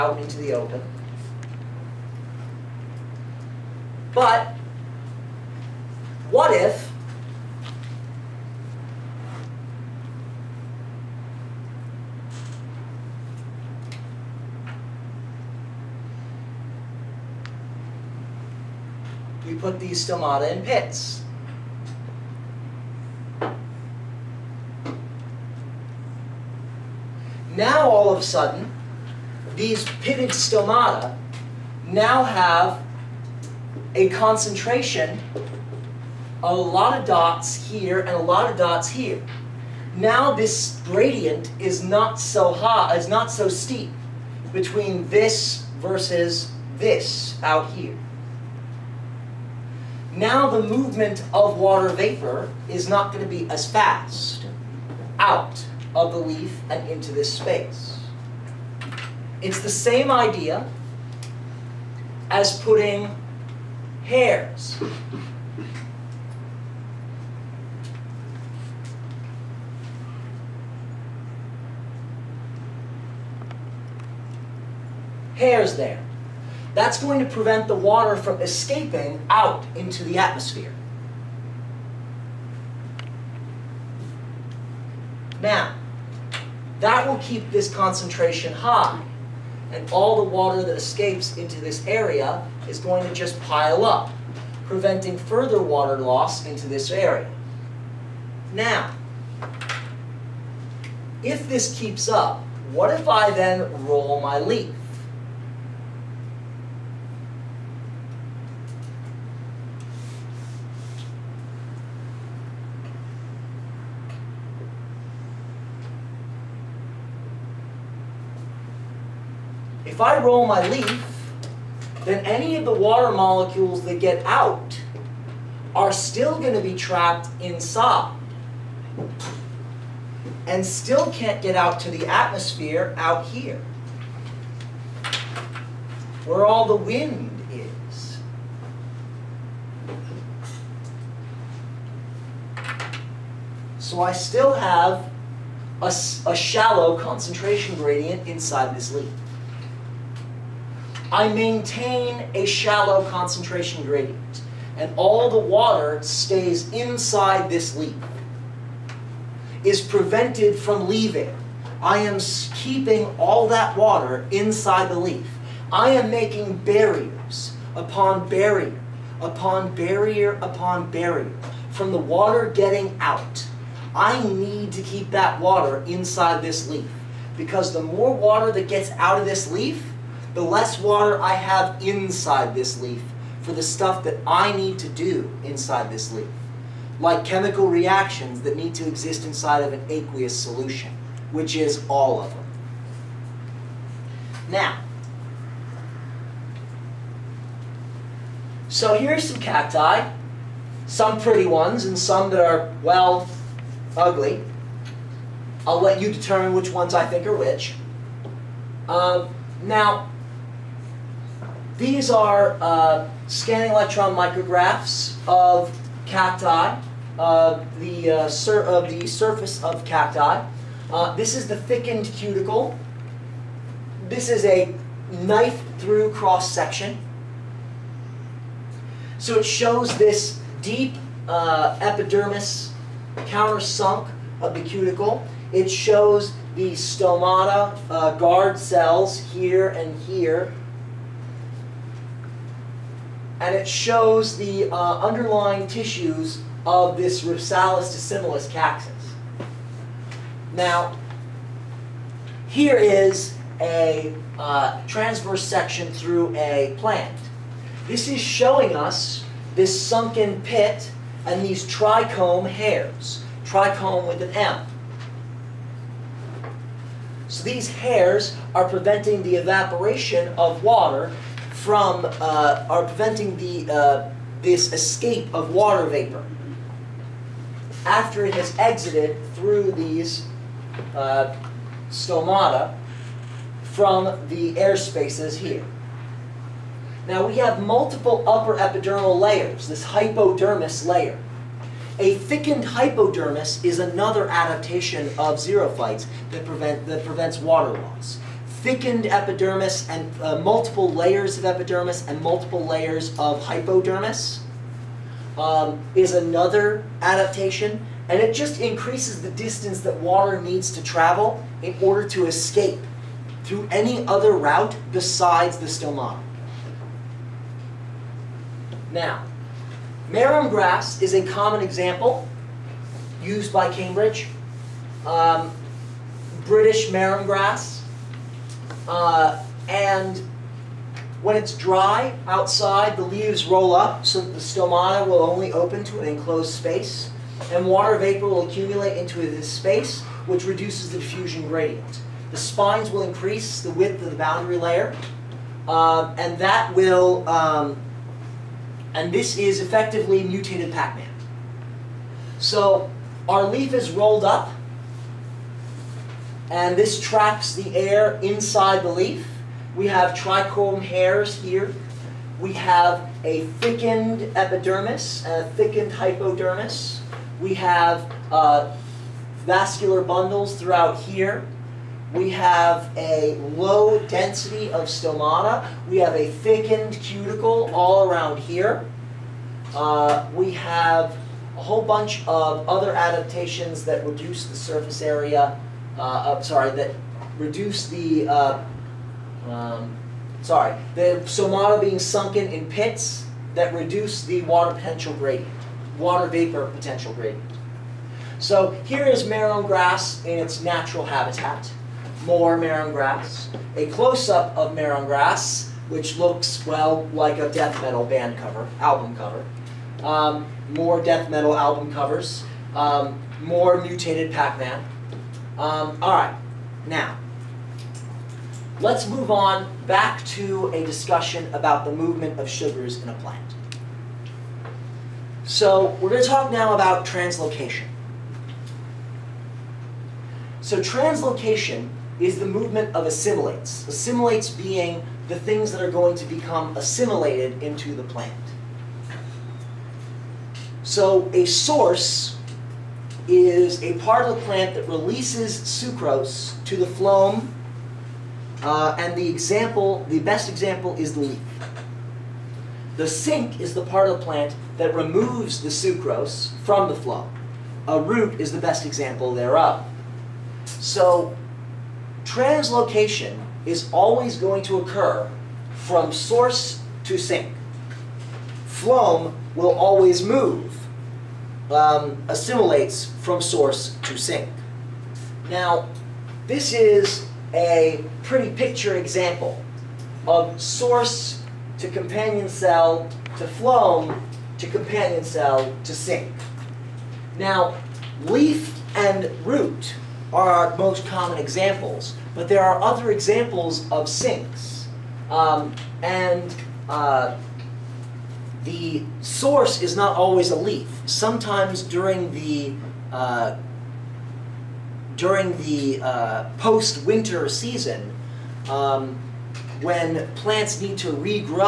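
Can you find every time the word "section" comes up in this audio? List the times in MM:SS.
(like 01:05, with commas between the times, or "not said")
03:46, 04:15.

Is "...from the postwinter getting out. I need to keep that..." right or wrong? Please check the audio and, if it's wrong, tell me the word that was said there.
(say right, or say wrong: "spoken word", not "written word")
wrong: "water", not "postwinter".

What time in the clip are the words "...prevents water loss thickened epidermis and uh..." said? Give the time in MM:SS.
04:57.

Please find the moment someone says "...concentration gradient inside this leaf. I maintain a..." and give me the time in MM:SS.
02:26.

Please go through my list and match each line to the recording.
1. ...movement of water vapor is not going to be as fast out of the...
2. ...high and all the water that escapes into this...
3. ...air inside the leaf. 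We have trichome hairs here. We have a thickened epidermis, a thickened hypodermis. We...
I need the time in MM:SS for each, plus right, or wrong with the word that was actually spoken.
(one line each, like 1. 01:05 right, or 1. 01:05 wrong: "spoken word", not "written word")
1. 00:50 right
2. 01:28 right
3. 05:57 right.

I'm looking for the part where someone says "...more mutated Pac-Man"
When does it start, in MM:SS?
06:53.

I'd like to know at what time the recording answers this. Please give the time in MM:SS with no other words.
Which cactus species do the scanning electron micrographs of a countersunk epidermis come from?
04:07.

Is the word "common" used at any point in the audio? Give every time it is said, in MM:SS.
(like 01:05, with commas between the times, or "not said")
05:21, 08:11.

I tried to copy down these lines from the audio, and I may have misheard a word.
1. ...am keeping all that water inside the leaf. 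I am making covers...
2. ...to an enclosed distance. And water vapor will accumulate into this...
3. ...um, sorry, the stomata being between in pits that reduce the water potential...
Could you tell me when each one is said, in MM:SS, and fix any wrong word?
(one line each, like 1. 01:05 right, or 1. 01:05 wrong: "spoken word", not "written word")
1. 02:41 wrong: "barriers", not "covers"
2. 05:35 wrong: "space", not "distance"
3. 06:29 wrong: "sunken", not "between".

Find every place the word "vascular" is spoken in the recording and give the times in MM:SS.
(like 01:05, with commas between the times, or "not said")
06:09.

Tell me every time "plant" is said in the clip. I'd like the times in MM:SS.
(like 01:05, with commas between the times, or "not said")
04:16, 07:03, 07:18, 07:24, 07:34, 08:30.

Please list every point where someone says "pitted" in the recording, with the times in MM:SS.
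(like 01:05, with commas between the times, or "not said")
00:30.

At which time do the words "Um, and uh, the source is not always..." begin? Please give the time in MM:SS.
08:15.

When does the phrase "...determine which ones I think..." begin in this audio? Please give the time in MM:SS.
03:26.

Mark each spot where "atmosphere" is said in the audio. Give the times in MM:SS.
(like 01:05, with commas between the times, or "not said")
01:20, 02:12.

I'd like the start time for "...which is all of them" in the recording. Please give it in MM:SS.
03:11.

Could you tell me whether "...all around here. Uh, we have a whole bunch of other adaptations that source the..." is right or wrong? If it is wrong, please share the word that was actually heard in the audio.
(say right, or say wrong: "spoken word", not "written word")
wrong: "reduce", not "source".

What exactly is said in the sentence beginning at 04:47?
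Now we have multiple upper epidermal layers, this hypodermis layer.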